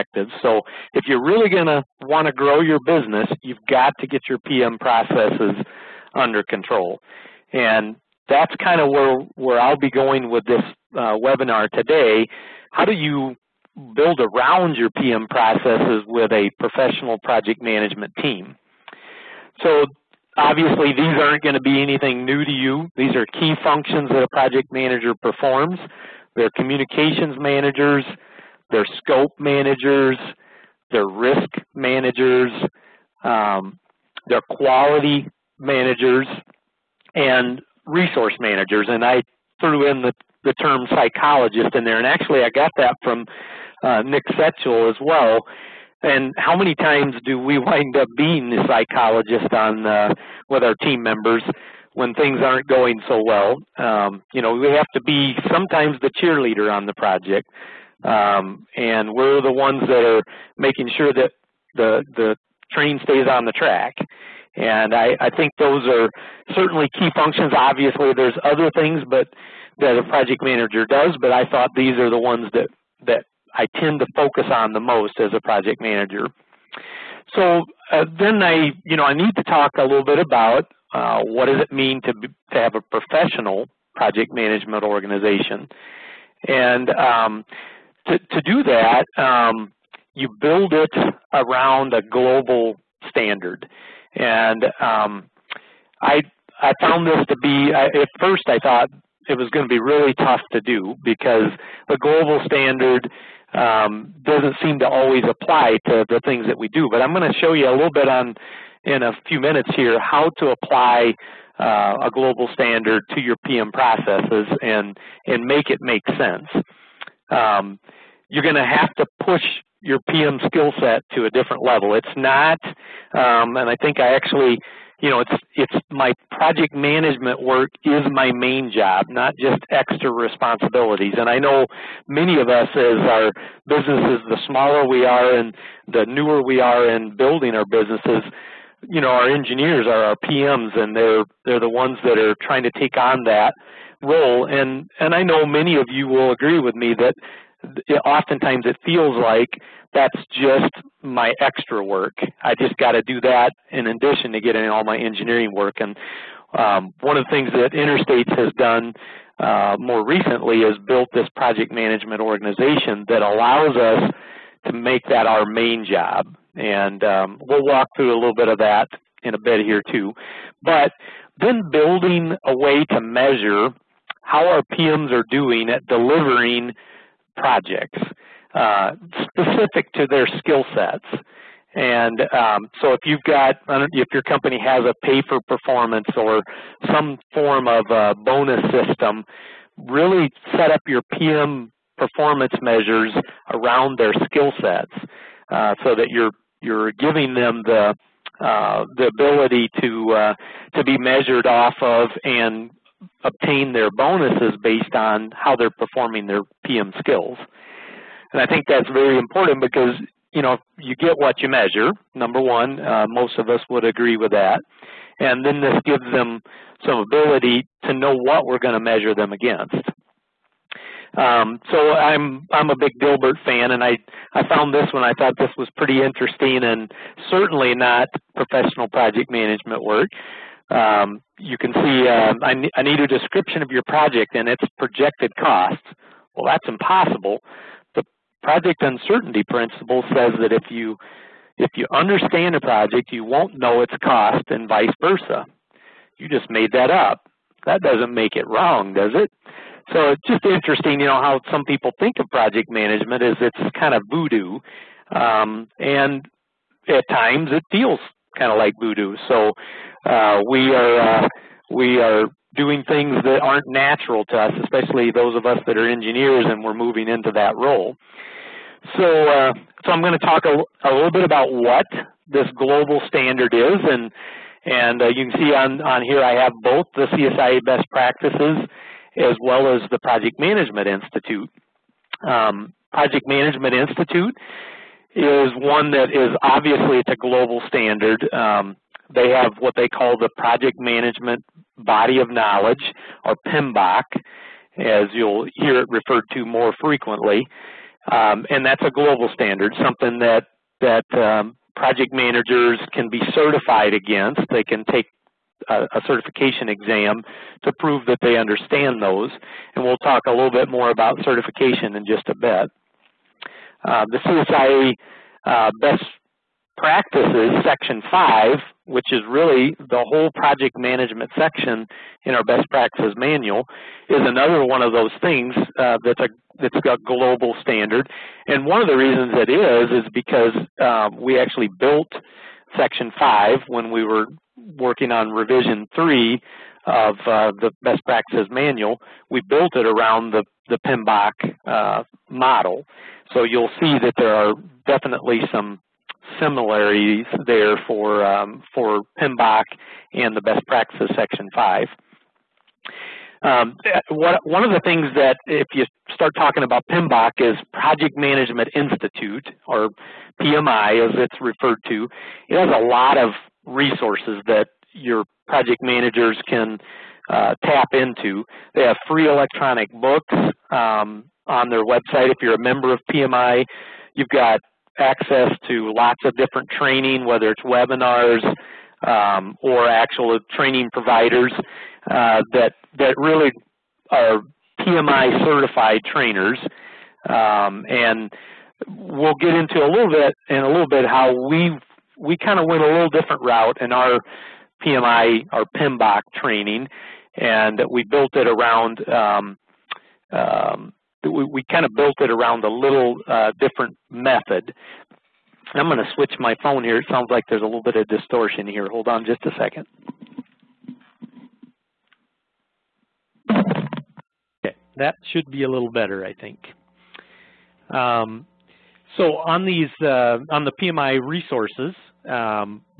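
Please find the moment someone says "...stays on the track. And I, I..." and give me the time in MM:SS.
01:03.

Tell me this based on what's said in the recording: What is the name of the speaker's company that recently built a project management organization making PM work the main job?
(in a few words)
Interstates.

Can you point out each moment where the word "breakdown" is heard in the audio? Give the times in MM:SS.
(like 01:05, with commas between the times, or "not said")
not said.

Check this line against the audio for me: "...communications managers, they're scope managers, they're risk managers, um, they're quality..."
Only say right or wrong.
right.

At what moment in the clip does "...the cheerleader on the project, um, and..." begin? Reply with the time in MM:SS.
00:56.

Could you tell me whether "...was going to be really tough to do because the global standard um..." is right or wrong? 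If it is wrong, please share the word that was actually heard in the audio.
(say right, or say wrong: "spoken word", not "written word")
right.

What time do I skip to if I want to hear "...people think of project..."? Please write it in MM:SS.
04:11.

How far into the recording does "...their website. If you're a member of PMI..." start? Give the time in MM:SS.
06:11.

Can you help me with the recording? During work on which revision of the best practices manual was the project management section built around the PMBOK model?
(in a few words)
Revision 3.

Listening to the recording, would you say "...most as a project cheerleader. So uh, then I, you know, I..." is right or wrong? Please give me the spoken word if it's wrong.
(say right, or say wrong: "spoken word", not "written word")
wrong: "manager", not "cheerleader".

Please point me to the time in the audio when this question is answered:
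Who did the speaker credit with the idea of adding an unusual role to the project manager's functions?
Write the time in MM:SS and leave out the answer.
00:44.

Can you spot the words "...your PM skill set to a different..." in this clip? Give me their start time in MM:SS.
01:59.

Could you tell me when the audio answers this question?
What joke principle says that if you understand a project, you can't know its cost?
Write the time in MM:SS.
03:58.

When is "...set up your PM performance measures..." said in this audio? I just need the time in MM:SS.
03:10.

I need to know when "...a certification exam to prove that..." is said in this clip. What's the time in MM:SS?
05:05.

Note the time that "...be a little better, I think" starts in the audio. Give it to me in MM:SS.
06:55.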